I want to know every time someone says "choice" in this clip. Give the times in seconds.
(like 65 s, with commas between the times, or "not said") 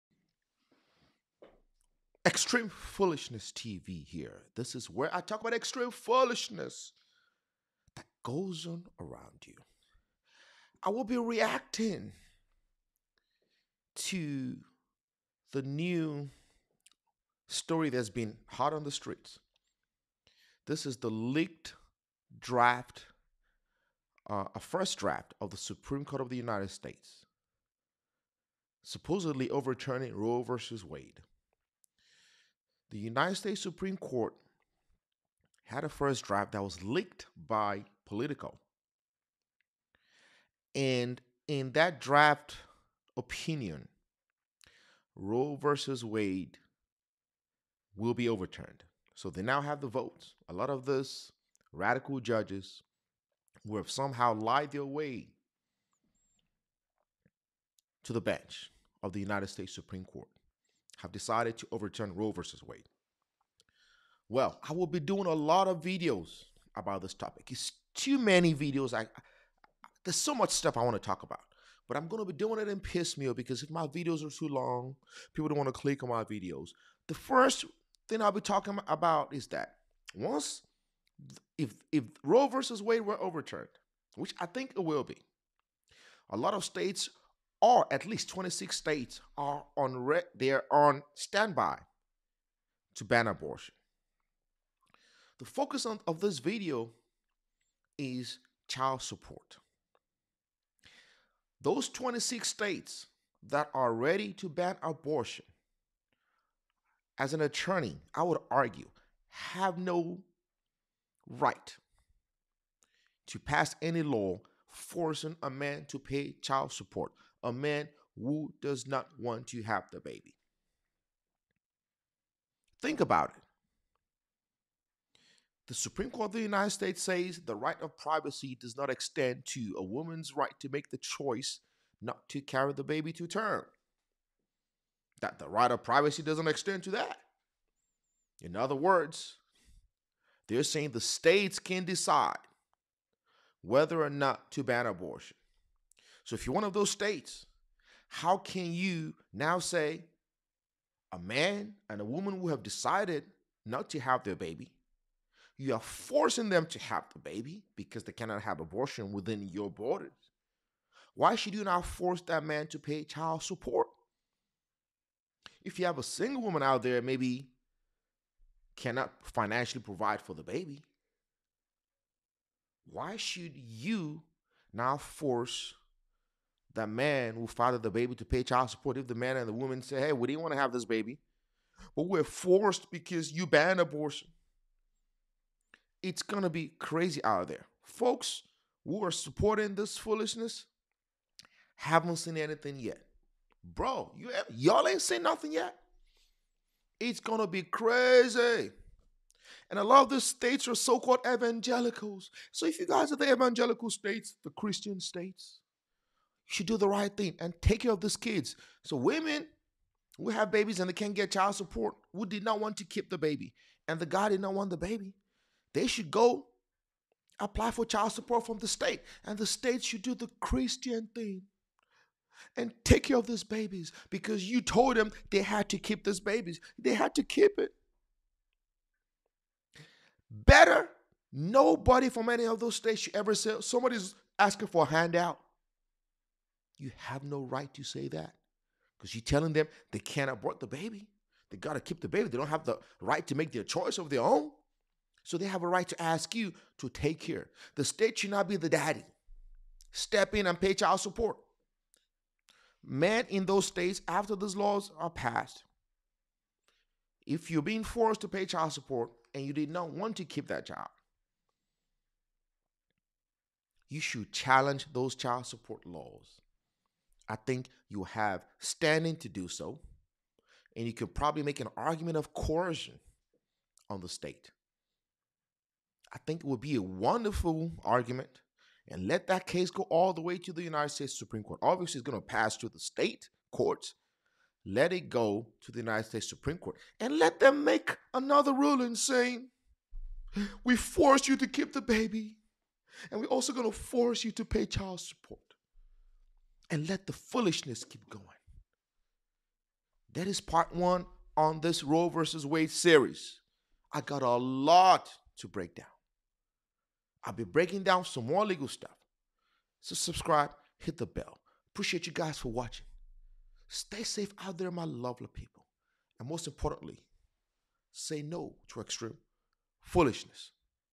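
130 s, 243 s.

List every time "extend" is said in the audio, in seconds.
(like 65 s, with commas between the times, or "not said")
128 s, 136 s.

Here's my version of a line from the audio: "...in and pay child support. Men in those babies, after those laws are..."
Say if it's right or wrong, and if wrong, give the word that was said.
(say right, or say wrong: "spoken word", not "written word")
wrong: "states", not "babies".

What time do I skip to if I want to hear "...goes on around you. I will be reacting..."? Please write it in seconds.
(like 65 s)
8 s.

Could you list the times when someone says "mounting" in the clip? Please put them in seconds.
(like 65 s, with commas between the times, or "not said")
not said.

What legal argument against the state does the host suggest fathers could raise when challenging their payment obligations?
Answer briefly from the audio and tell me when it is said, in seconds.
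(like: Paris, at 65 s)
Coercion, at 272 s.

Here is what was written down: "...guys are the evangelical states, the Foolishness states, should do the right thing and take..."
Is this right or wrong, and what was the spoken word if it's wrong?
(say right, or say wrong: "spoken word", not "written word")
wrong: "Christian", not "Foolishness".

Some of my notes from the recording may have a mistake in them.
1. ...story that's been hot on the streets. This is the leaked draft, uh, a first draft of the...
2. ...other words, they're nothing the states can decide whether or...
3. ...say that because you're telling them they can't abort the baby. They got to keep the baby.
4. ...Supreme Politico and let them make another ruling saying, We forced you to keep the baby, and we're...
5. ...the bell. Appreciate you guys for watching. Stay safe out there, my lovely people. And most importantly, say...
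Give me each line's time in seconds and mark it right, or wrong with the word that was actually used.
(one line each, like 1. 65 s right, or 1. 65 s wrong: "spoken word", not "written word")
1. 17 s right
2. 138 s wrong: "saying", not "nothing"
3. 237 s right
4. 286 s wrong: "Court", not "Politico"
5. 310 s right.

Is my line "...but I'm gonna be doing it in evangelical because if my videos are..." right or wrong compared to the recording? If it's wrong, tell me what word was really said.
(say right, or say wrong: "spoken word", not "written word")
wrong: "piecemeal", not "evangelical".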